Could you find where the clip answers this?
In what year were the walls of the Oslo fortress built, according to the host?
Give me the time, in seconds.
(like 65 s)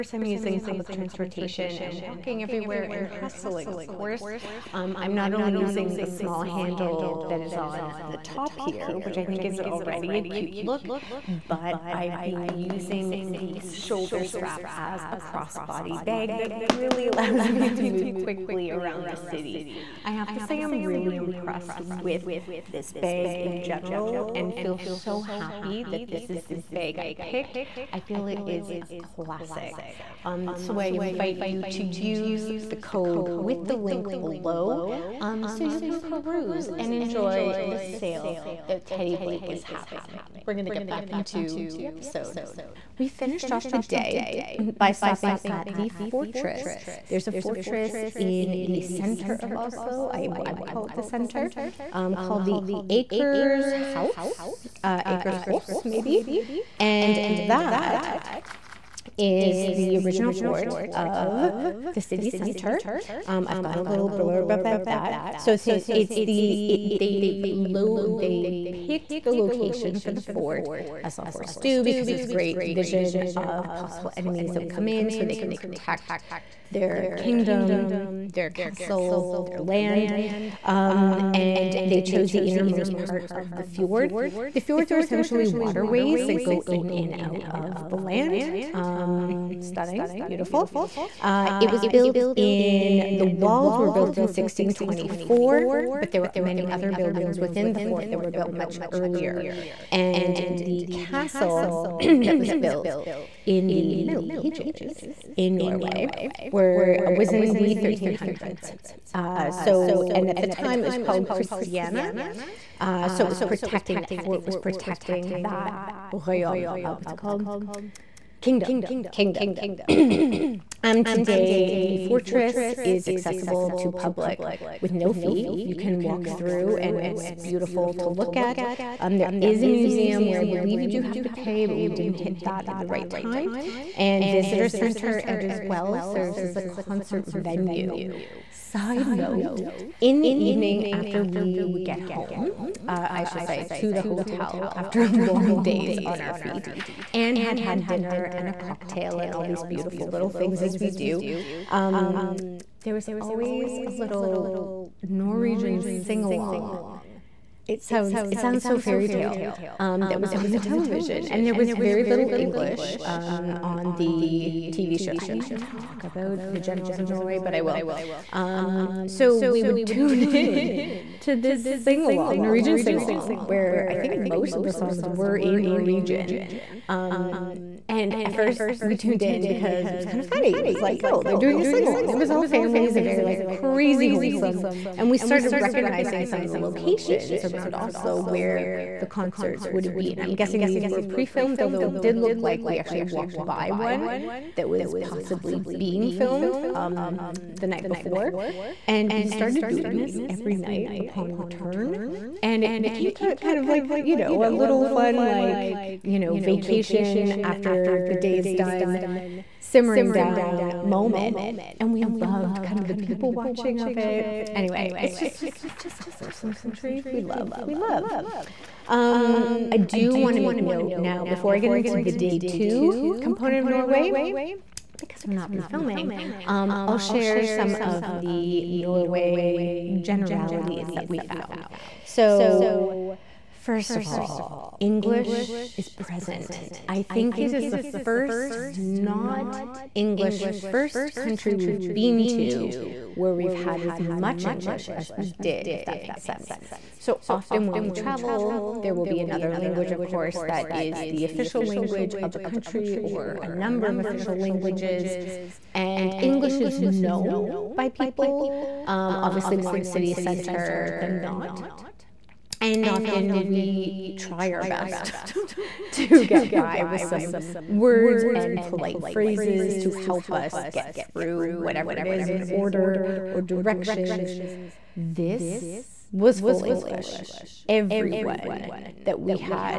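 94 s.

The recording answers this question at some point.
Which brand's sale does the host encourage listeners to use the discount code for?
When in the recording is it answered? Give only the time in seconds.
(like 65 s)
38 s.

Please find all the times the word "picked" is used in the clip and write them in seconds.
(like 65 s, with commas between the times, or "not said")
27 s, 68 s.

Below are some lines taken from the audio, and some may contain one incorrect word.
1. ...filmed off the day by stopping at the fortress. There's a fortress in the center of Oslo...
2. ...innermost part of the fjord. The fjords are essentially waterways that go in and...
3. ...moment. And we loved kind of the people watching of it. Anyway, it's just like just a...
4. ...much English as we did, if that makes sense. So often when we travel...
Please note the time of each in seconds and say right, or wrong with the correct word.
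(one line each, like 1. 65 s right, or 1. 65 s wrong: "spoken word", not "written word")
1. 43 s wrong: "finished", not "filmed"
2. 82 s right
3. 210 s right
4. 244 s right.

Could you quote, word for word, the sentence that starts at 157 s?
It sounds it sounds so fairy tale, um, that was on the television.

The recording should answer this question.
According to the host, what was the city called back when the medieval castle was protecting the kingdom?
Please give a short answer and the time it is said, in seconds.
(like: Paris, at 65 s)
Christiana, at 111 s.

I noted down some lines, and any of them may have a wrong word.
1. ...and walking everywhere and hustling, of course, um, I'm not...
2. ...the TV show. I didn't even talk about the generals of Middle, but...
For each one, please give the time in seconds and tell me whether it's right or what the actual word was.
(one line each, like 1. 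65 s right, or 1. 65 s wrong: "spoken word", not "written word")
1. 1 s right
2. 163 s wrong: "Norway", not "Middle".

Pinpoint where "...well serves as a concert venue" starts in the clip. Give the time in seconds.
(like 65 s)
135 s.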